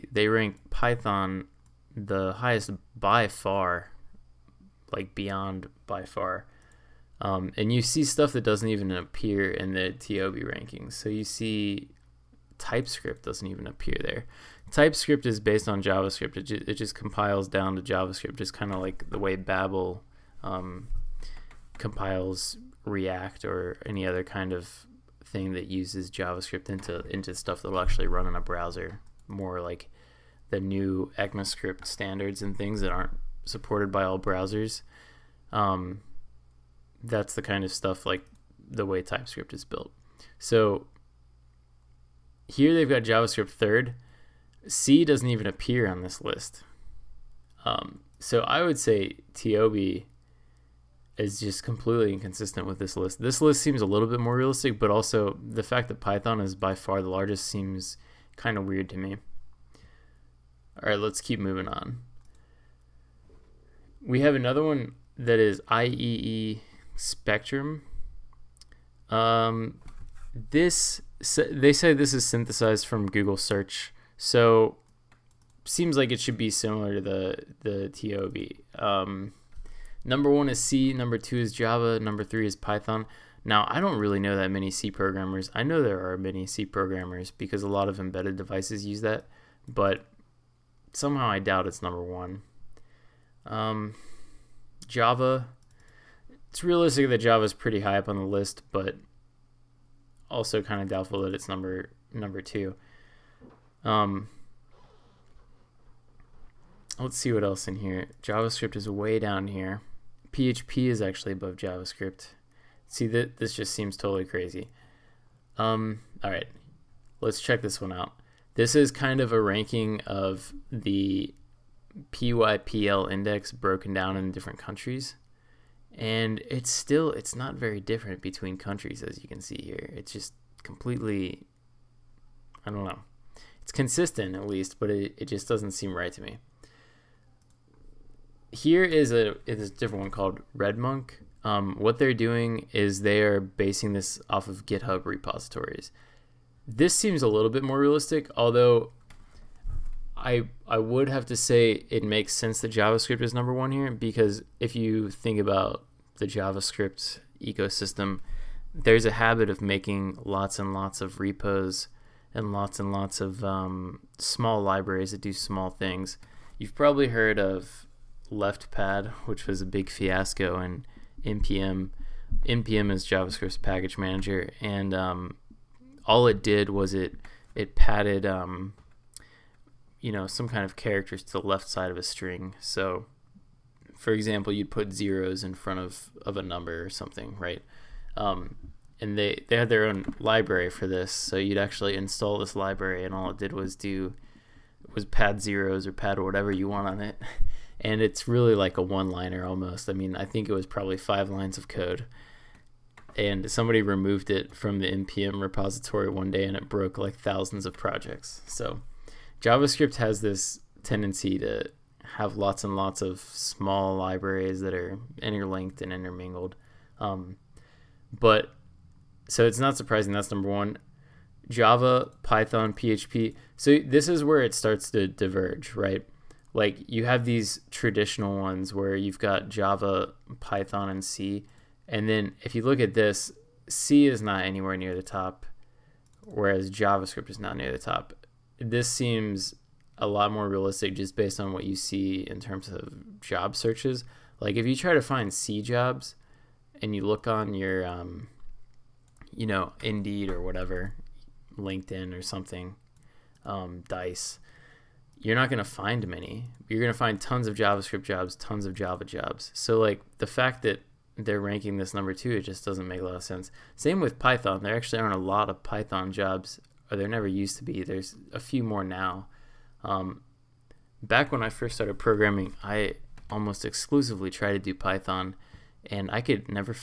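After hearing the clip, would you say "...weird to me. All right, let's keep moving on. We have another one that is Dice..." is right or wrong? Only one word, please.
wrong.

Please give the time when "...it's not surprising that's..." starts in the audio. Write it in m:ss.
3:39.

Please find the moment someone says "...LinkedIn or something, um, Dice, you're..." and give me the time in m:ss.
4:11.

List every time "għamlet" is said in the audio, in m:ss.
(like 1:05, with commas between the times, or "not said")
not said.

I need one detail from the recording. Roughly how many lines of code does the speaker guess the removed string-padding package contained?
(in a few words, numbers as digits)
5.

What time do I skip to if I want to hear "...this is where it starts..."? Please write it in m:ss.
3:43.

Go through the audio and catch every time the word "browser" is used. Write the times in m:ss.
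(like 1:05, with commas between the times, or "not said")
0:28, 0:34.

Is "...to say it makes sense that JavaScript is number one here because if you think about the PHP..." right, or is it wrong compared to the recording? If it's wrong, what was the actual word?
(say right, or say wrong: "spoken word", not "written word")
wrong: "JavaScript", not "PHP".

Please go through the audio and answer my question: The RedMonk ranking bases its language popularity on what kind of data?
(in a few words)
GitHub repositories.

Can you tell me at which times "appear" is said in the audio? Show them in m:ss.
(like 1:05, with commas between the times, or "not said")
0:08, 0:13, 0:45.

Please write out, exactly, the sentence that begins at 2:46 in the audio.
You've probably heard of LeftPad, which was a big fiasco, and npm.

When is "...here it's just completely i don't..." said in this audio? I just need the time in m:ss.
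2:09.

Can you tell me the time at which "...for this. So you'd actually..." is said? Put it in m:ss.
3:10.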